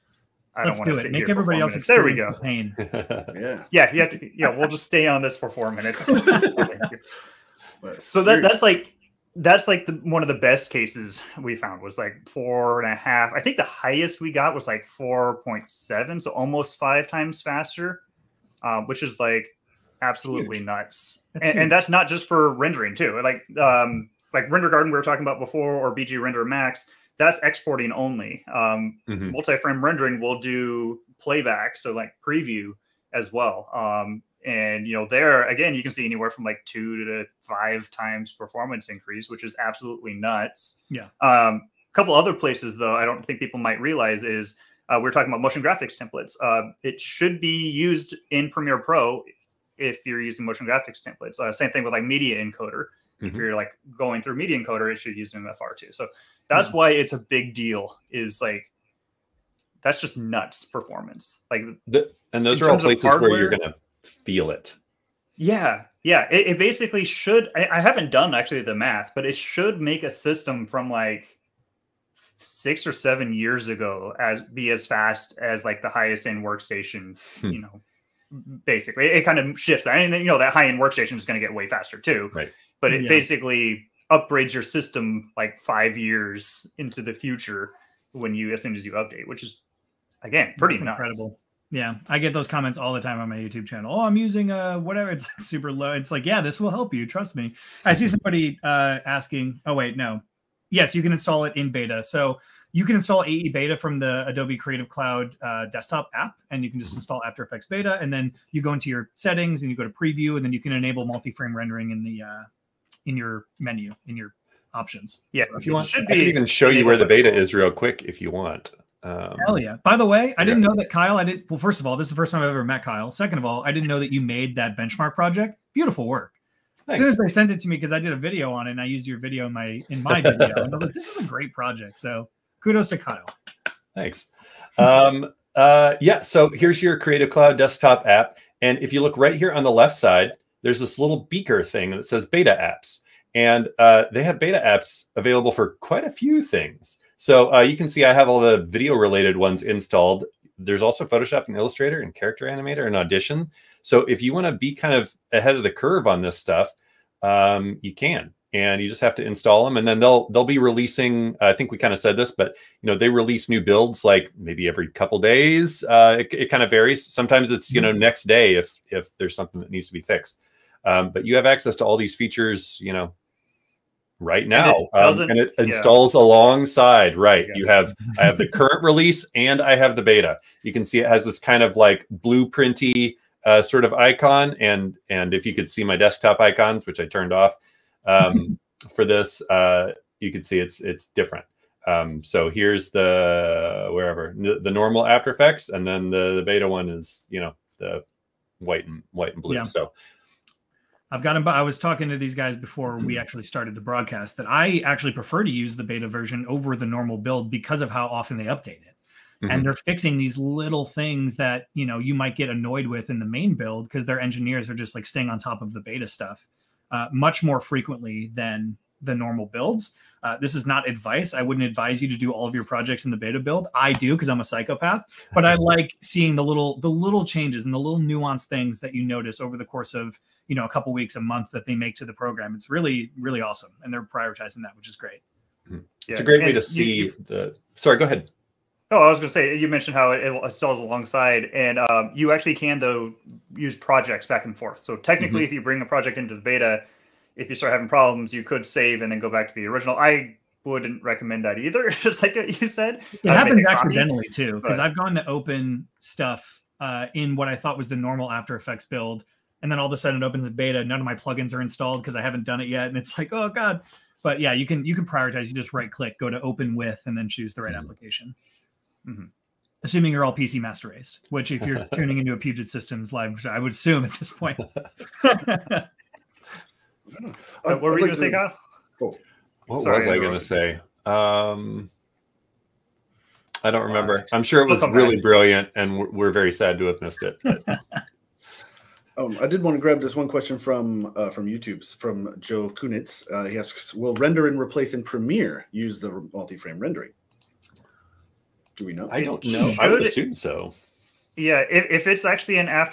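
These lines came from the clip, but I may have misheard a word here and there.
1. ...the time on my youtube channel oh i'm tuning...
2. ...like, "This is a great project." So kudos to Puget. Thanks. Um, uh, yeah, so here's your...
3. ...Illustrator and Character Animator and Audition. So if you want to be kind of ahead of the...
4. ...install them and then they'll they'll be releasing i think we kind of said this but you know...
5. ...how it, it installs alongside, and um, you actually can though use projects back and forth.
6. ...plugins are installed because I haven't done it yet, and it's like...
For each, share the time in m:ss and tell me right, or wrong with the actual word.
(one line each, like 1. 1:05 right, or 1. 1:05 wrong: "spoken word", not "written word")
1. 1:32 wrong: "using", not "tuning"
2. 2:10 wrong: "Kyle", not "Puget"
3. 2:31 right
4. 2:39 right
5. 3:59 right
6. 4:21 right.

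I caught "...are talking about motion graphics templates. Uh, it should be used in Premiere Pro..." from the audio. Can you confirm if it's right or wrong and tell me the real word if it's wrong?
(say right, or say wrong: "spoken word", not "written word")
right.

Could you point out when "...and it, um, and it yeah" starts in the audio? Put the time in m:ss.
2:54.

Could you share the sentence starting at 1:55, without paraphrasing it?
Yeah, so if you want, should be I can even show you where the beta is real quick if you want.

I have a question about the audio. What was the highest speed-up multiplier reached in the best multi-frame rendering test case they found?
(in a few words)
4.7.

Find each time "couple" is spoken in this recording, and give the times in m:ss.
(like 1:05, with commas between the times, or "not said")
0:41, 2:44, 3:50.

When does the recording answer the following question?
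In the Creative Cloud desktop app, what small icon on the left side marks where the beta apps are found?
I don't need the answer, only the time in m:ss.
2:21.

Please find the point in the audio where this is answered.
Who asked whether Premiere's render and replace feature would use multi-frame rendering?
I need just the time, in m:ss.
4:52.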